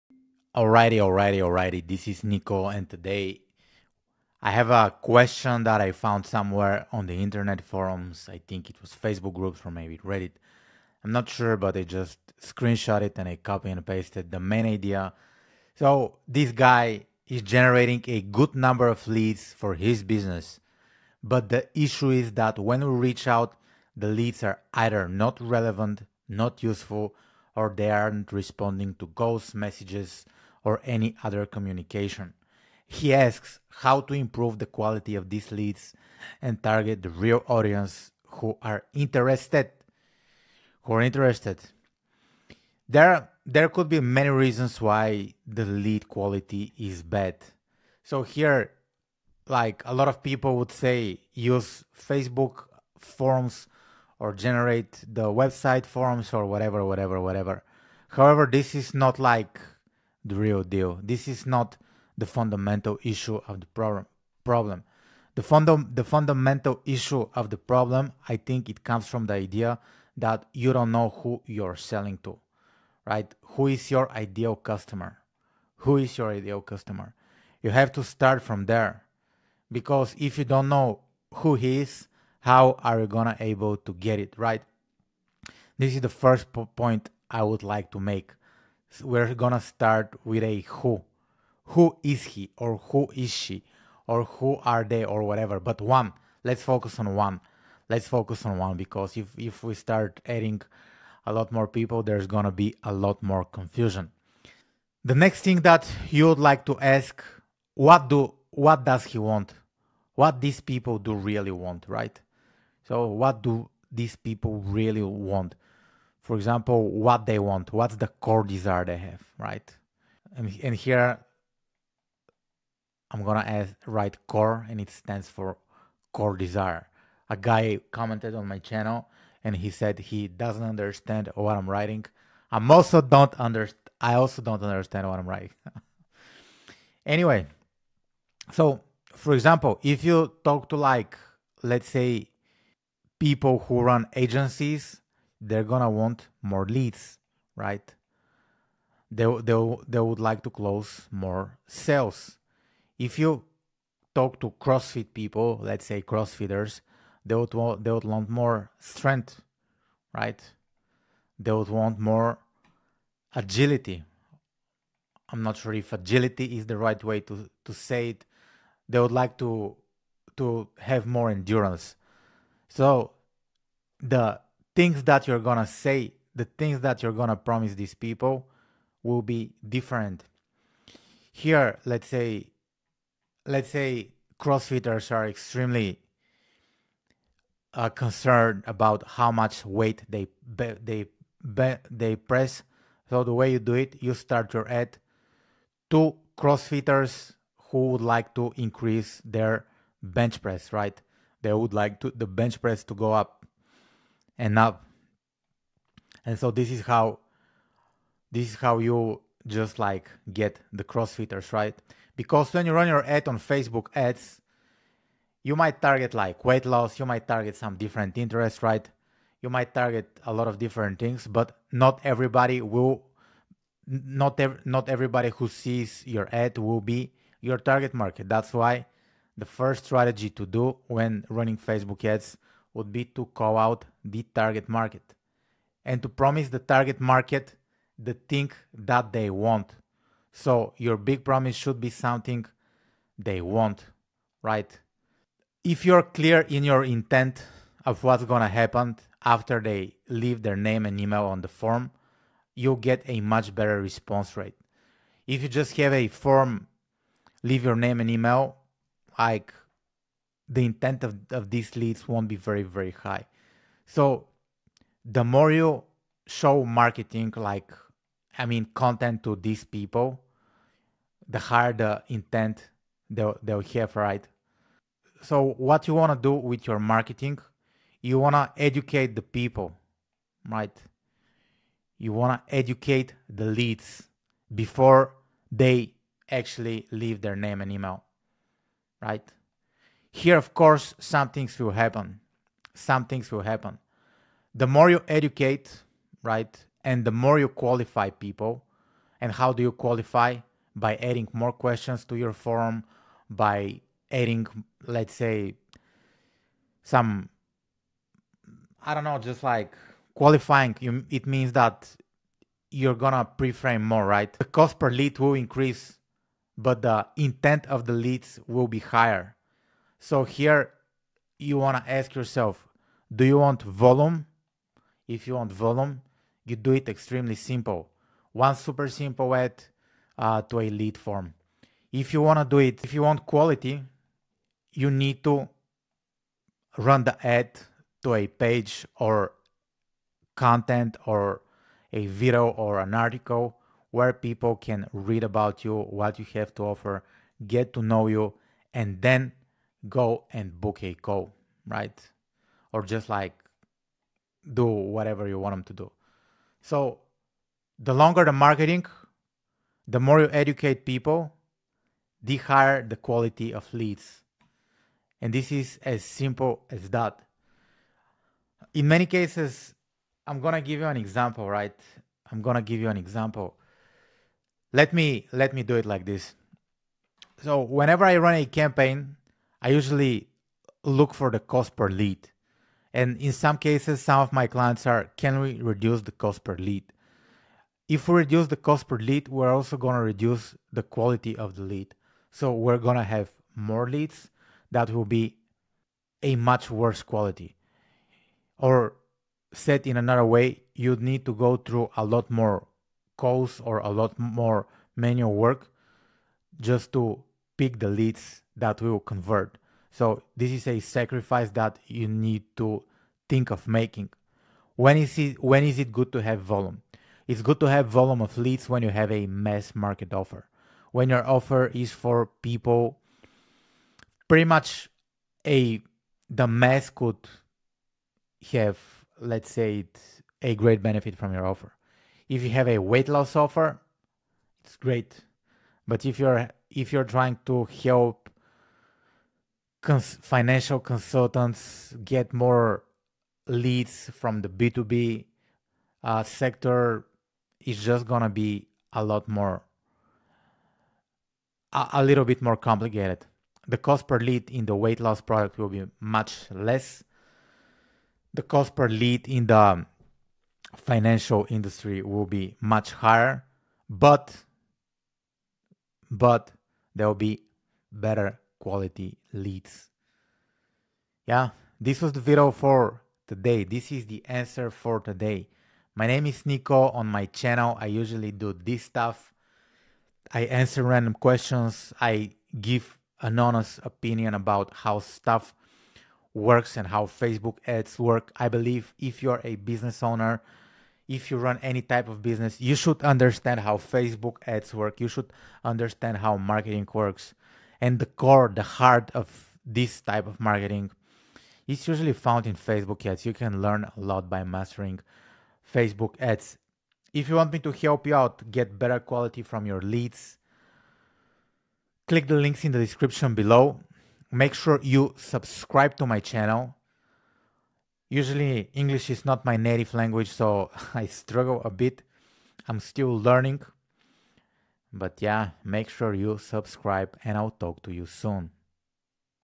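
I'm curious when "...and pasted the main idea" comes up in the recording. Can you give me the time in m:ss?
0:13.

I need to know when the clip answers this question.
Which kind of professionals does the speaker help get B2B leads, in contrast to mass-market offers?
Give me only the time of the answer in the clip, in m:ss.
7:20.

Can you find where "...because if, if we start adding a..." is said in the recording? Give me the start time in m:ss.
1:38.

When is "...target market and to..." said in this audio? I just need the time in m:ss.
3:54.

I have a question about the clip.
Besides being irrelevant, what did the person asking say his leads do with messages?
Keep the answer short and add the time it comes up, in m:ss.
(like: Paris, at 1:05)
Ghost messages, at 0:29.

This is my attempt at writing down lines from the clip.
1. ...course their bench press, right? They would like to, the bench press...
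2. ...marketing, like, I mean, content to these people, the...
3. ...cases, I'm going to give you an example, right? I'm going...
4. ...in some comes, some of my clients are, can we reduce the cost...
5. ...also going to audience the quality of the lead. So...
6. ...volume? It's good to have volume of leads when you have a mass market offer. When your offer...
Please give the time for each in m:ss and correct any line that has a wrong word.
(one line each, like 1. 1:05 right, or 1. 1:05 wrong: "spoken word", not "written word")
1. 3:18 wrong: "increase", not "course"
2. 4:26 right
3. 6:09 right
4. 6:23 wrong: "cases", not "comes"
5. 6:29 wrong: "reduce", not "audience"
6. 6:56 right.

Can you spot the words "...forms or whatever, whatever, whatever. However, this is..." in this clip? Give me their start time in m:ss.
0:55.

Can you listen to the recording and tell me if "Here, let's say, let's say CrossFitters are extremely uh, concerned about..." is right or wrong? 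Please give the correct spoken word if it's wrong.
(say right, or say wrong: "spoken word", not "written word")
right.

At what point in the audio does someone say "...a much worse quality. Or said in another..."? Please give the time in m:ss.
6:36.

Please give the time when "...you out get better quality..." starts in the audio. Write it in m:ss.
8:28.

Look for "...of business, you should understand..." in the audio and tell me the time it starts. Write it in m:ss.
8:12.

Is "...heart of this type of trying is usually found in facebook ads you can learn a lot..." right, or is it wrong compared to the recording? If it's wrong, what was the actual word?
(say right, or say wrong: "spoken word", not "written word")
wrong: "marketing", not "trying".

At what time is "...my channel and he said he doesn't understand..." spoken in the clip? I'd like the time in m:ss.
2:08.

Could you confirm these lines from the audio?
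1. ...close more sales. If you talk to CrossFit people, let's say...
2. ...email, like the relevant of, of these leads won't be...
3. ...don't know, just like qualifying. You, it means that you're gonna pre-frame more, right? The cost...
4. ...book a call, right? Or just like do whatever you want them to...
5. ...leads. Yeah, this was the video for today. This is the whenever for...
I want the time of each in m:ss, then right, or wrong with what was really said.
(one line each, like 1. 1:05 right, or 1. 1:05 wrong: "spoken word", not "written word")
1. 2:30 right
2. 4:18 wrong: "intent", not "relevant"
3. 5:08 right
4. 5:50 right
5. 7:49 wrong: "answer", not "whenever".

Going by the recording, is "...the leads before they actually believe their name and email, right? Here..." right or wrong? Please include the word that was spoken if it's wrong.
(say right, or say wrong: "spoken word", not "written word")
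wrong: "leave", not "believe".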